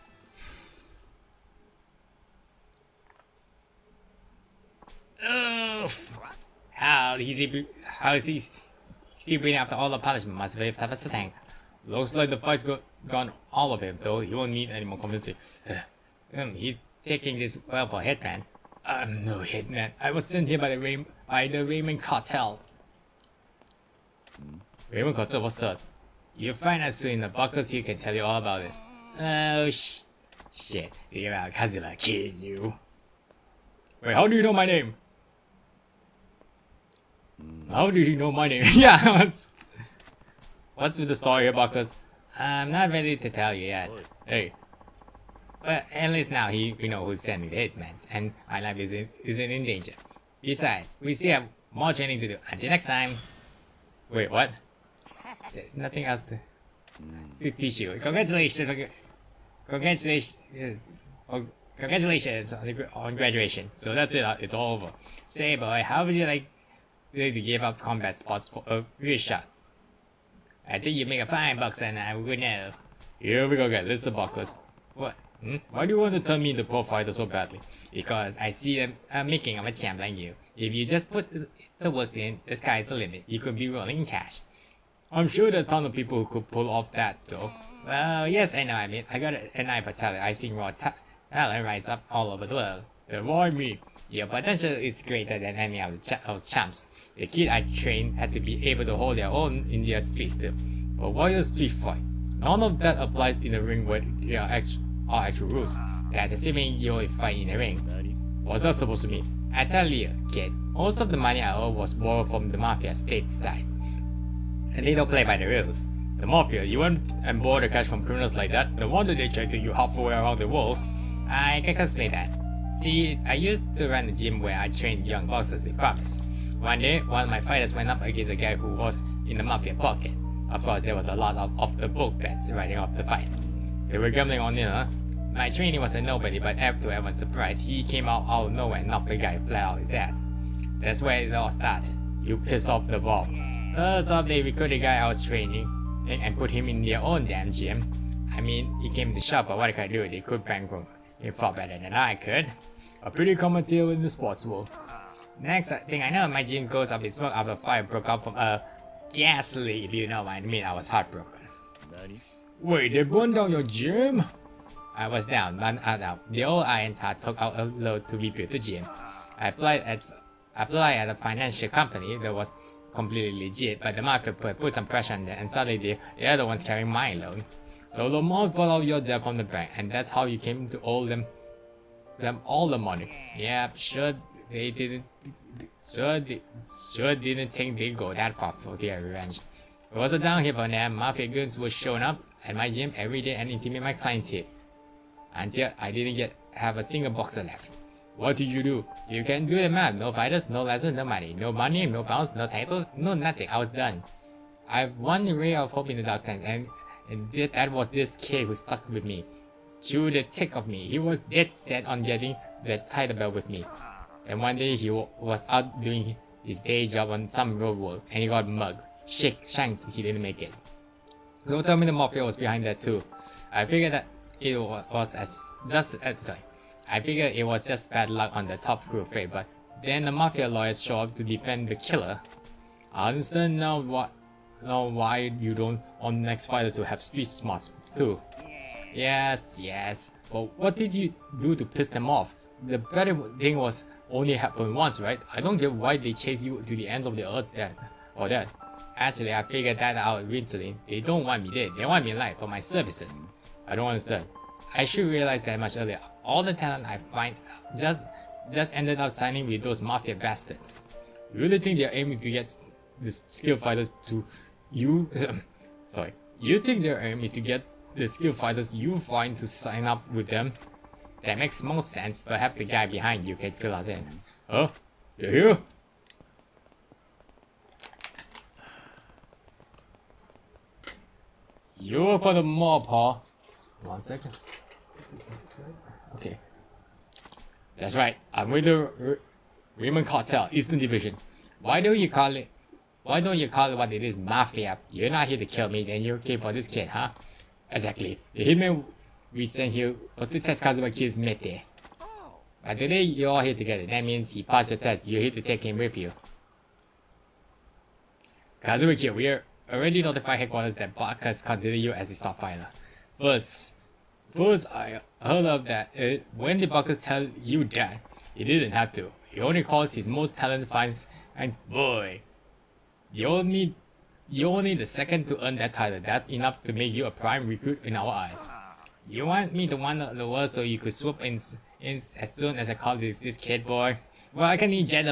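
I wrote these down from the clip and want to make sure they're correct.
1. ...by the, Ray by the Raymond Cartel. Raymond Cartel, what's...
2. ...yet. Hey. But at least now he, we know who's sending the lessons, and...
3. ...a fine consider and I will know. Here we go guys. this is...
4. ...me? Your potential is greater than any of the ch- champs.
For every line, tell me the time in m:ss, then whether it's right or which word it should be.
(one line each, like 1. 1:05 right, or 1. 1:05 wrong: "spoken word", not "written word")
1. 0:20 right
2. 0:43 wrong: "hitmans", not "lessons"
3. 1:11 wrong: "boxer", not "consider"
4. 1:33 right.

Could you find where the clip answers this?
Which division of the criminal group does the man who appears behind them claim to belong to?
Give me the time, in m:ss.
4:50.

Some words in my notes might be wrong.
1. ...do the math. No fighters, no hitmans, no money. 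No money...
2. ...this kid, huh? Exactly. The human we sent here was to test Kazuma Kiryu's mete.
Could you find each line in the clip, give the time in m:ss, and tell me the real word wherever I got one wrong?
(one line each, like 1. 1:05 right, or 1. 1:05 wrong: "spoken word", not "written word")
1. 3:19 wrong: "lessons", not "hitmans"
2. 4:56 right.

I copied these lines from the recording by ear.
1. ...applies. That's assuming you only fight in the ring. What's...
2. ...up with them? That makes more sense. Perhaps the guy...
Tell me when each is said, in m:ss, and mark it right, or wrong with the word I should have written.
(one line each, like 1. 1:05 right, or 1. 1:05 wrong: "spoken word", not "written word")
1. 1:45 wrong: "rules", not "applies"
2. 4:29 right.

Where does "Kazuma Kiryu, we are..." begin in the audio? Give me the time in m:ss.
5:08.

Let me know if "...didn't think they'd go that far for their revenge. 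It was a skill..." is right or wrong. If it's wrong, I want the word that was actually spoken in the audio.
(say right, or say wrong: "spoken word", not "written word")
wrong: "downhill", not "skill".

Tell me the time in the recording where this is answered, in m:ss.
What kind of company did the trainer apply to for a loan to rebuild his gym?
2:51.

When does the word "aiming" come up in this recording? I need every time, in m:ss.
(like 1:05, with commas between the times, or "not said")
4:21.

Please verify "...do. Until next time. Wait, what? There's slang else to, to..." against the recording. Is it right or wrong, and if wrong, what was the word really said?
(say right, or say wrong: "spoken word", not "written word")
wrong: "nothing", not "slang".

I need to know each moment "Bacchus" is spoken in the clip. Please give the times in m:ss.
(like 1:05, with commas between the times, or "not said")
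5:10, 5:16.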